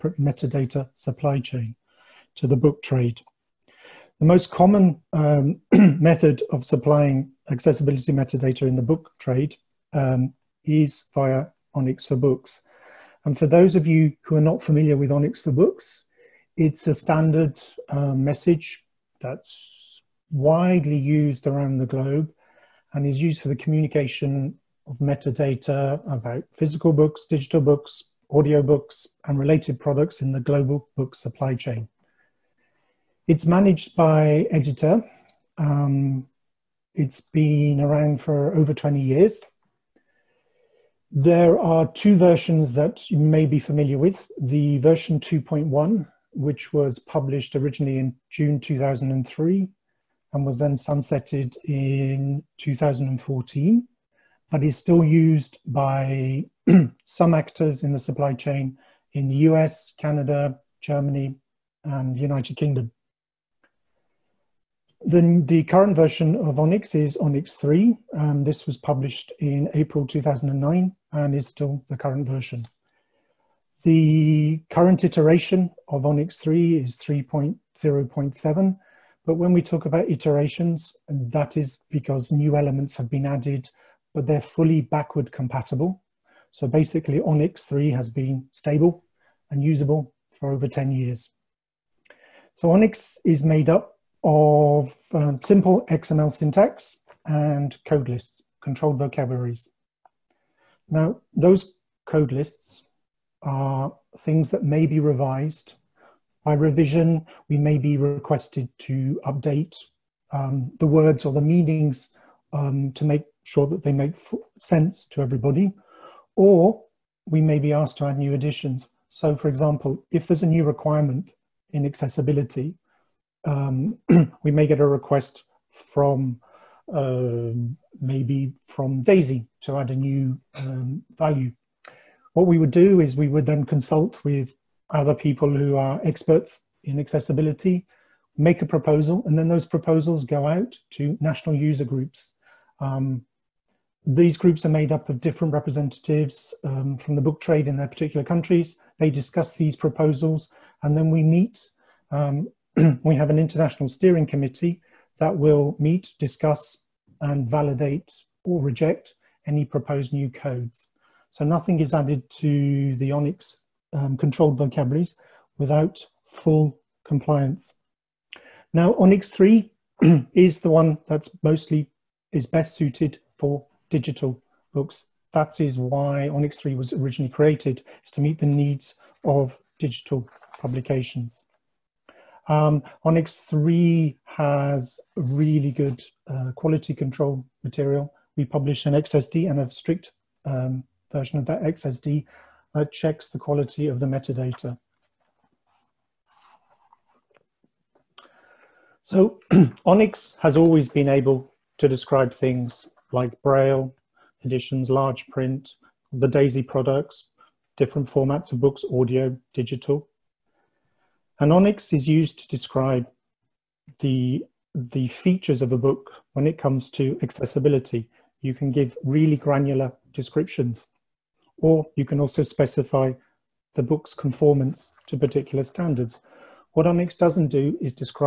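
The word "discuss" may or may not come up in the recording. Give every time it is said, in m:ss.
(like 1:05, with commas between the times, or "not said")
2:29, 2:36.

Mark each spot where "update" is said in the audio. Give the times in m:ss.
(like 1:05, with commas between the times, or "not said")
1:49.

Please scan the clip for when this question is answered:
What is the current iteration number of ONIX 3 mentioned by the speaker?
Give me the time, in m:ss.
1:16.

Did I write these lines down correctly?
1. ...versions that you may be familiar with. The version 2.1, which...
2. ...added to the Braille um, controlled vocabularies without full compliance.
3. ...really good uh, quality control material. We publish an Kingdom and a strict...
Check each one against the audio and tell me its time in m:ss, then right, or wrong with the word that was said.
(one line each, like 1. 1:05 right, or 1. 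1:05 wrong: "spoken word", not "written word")
1. 0:42 right
2. 2:41 wrong: "ONIX", not "Braille"
3. 3:05 wrong: "XSD", not "Kingdom".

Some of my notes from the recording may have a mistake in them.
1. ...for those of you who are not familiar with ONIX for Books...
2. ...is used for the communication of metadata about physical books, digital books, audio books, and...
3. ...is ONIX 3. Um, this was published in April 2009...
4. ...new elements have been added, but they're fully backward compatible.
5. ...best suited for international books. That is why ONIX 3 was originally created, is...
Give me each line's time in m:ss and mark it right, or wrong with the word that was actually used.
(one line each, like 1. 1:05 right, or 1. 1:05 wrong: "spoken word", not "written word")
1. 0:13 right
2. 0:23 right
3. 1:06 right
4. 1:22 right
5. 2:52 wrong: "digital", not "international".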